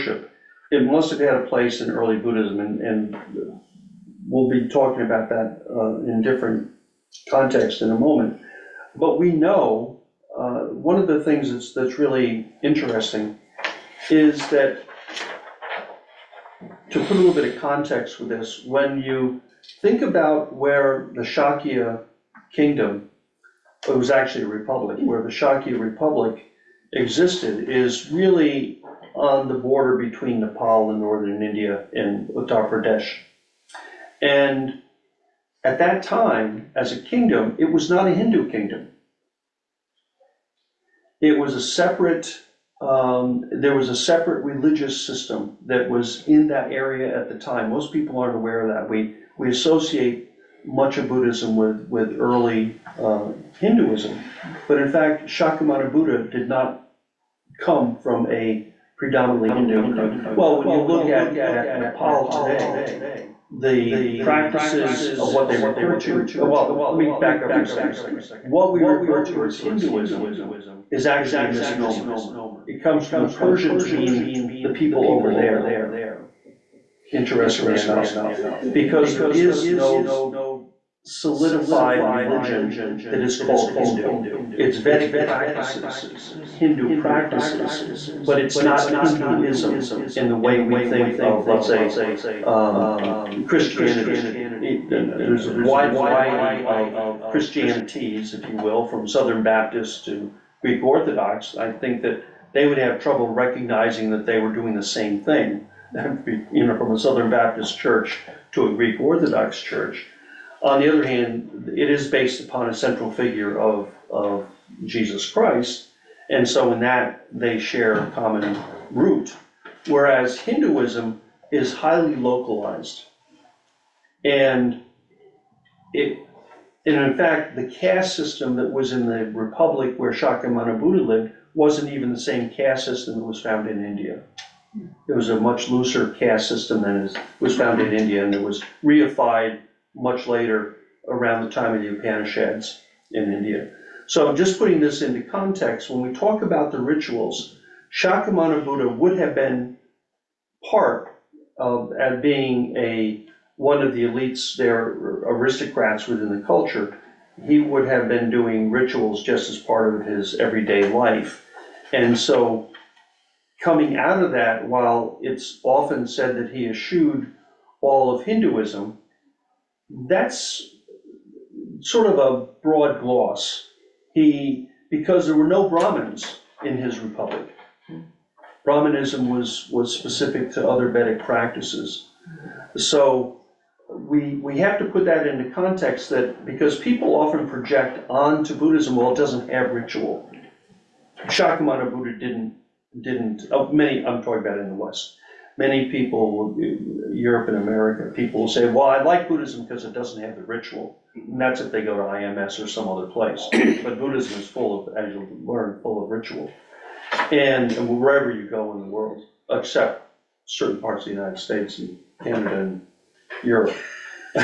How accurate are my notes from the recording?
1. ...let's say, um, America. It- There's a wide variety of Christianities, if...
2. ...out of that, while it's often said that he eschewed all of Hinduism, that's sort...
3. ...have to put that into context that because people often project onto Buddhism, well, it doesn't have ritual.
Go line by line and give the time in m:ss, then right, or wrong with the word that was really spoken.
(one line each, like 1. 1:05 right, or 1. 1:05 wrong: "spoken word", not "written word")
1. 1:31 wrong: "Christianity", not "America"
2. 2:43 right
3. 3:04 right.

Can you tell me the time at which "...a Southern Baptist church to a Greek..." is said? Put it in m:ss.
1:46.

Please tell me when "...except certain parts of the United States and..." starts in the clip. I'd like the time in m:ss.
3:29.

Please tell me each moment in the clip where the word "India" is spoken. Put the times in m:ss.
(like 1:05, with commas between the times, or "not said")
0:31, 2:13, 2:17, 2:23.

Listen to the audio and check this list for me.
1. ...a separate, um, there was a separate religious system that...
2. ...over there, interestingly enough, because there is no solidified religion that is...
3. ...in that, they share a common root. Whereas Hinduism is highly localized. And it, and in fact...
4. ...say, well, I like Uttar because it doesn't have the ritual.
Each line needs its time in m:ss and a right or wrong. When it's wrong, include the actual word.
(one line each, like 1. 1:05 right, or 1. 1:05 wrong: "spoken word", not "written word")
1. 0:41 right
2. 1:15 right
3. 1:56 right
4. 3:18 wrong: "Buddhism", not "Uttar".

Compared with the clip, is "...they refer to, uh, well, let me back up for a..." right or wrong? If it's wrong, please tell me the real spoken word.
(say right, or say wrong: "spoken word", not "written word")
right.